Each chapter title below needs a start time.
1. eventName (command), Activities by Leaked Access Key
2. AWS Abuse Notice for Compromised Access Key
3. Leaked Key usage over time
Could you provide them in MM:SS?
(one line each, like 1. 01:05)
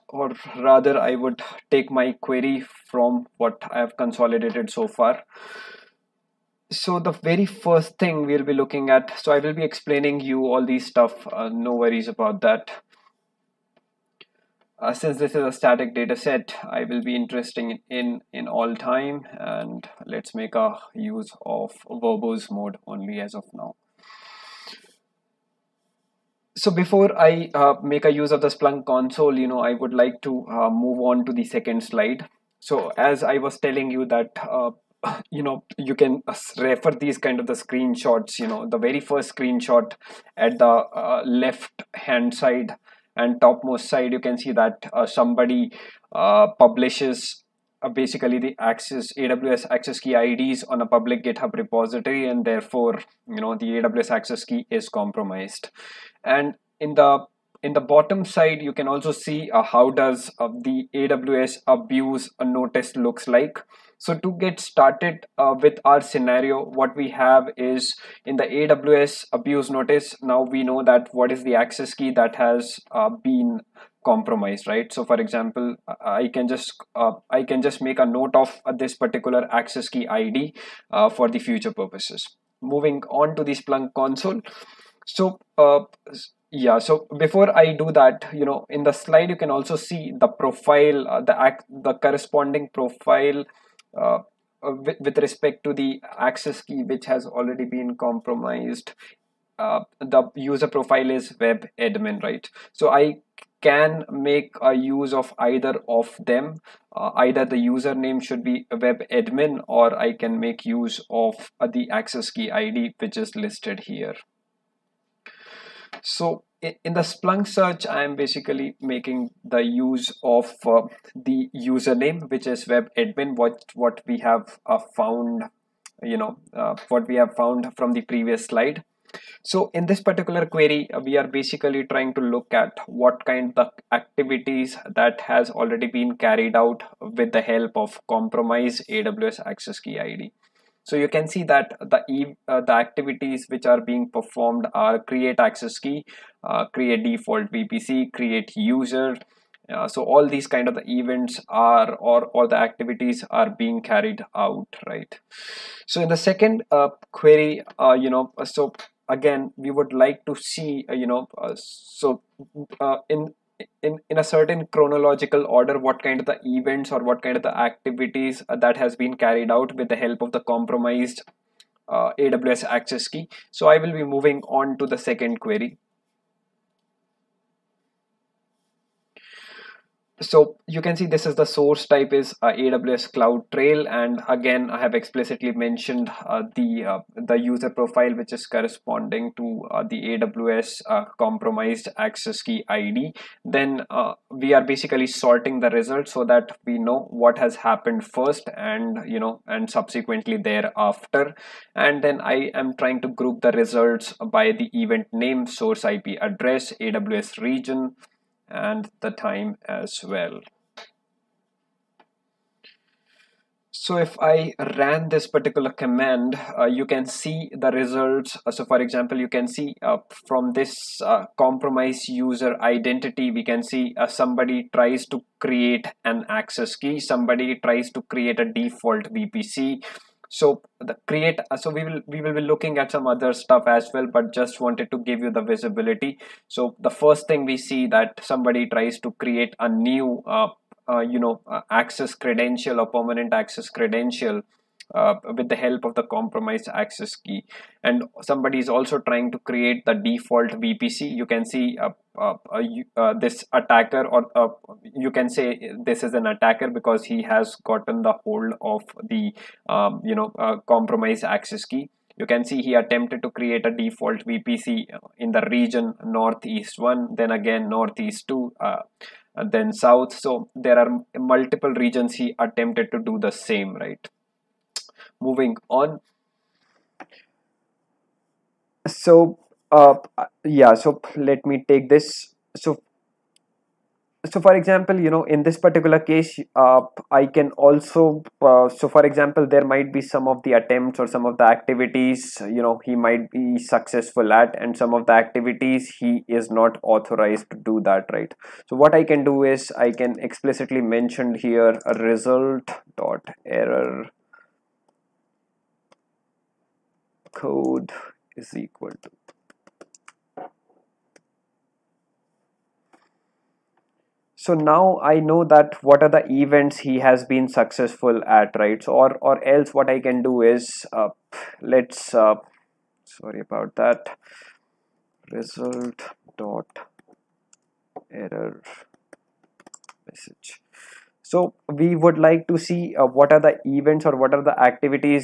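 1. 01:59
2. 00:32
3. 02:37.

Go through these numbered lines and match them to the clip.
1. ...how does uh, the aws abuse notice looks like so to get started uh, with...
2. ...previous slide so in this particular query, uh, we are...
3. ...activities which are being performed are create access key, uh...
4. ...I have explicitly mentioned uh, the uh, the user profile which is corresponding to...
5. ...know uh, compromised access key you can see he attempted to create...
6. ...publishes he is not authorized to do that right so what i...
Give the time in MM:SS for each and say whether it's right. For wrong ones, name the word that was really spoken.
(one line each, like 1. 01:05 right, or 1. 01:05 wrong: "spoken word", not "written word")
1. 00:59 right
2. 02:08 right
3. 02:22 right
4. 03:04 right
5. 04:20 right
6. 04:55 wrong: "activities", not "publishes".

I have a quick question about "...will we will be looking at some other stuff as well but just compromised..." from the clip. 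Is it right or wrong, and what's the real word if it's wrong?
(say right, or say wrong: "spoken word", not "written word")
wrong: "wanted", not "compromised".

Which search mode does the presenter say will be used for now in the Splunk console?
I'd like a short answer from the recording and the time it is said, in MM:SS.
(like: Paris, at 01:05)
Verbose mode, at 00:21.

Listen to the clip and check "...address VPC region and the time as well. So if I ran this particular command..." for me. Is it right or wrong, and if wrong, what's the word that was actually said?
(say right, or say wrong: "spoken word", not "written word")
wrong: "AWS", not "VPC".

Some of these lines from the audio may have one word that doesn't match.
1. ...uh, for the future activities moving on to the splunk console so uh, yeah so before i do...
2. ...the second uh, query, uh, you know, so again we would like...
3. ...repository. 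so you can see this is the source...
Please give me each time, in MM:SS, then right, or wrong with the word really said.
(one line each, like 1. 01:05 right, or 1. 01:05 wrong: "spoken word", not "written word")
1. 01:20 wrong: "purposes", not "activities"
2. 02:36 right
3. 02:55 wrong: "query", not "repository".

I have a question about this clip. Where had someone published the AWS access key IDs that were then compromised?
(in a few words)
Public GitHub repository.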